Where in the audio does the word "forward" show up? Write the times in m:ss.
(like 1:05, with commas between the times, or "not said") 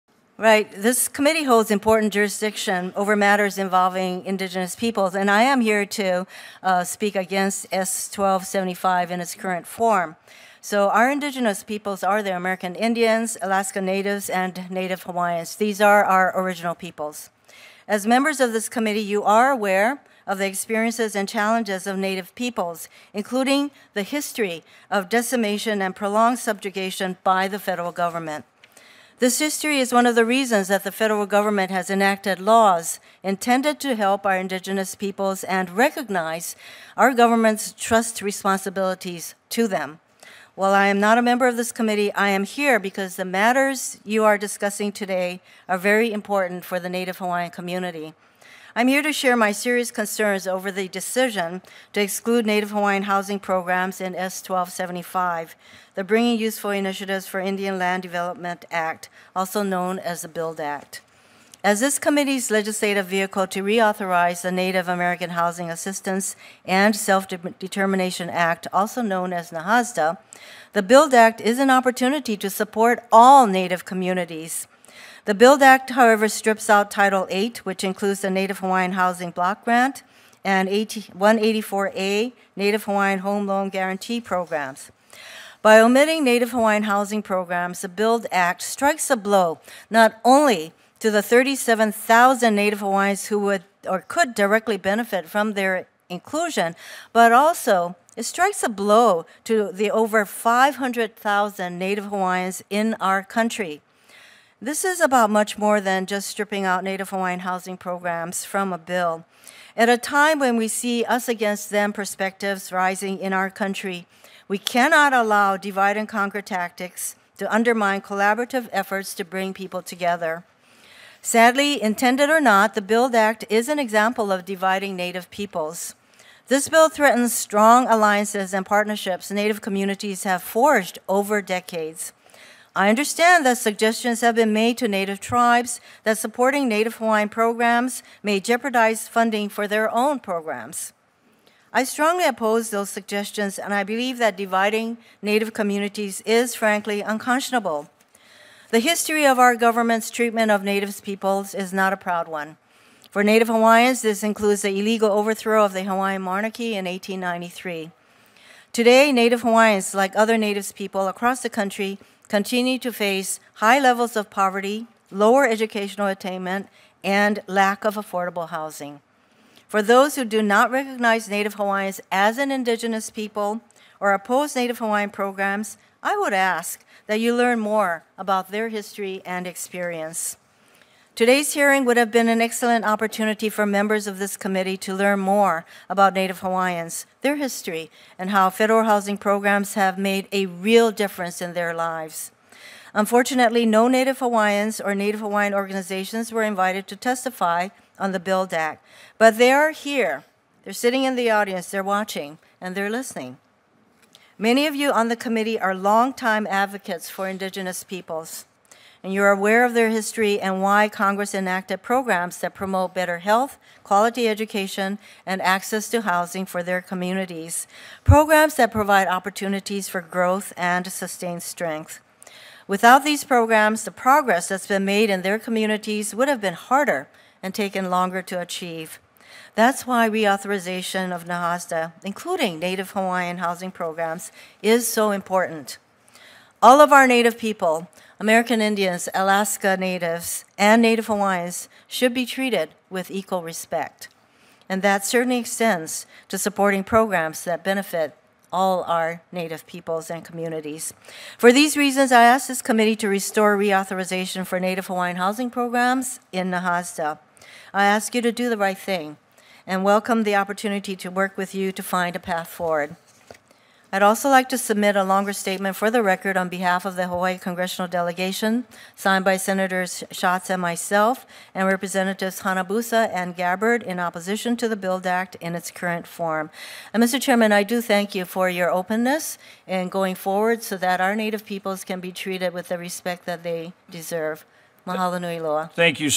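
4:22, 4:40.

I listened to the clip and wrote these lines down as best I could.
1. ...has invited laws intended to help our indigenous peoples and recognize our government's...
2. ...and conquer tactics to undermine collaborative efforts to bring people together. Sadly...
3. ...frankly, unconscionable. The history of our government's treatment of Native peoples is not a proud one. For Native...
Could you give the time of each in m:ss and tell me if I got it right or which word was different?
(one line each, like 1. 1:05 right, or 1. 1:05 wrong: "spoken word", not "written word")
1. 0:31 wrong: "enacted", not "invited"
2. 1:55 right
3. 2:26 right.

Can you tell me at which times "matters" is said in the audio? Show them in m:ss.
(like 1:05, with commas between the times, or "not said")
0:03, 0:43.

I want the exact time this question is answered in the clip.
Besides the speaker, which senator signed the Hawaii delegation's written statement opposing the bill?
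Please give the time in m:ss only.
4:30.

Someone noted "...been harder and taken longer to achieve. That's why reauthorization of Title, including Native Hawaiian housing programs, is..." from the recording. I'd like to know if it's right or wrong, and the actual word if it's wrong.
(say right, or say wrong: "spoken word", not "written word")
wrong: "NAHASDA", not "Title".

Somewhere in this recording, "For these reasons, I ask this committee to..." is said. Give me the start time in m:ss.
4:11.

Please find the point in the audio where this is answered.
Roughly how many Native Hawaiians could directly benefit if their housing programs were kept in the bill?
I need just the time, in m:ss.
1:31.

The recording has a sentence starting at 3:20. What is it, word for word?
They're sitting in the audience, they're watching, and they're listening.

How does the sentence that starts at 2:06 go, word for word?
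This bill threatens strong alliances and partnerships Native communities have forged over decades.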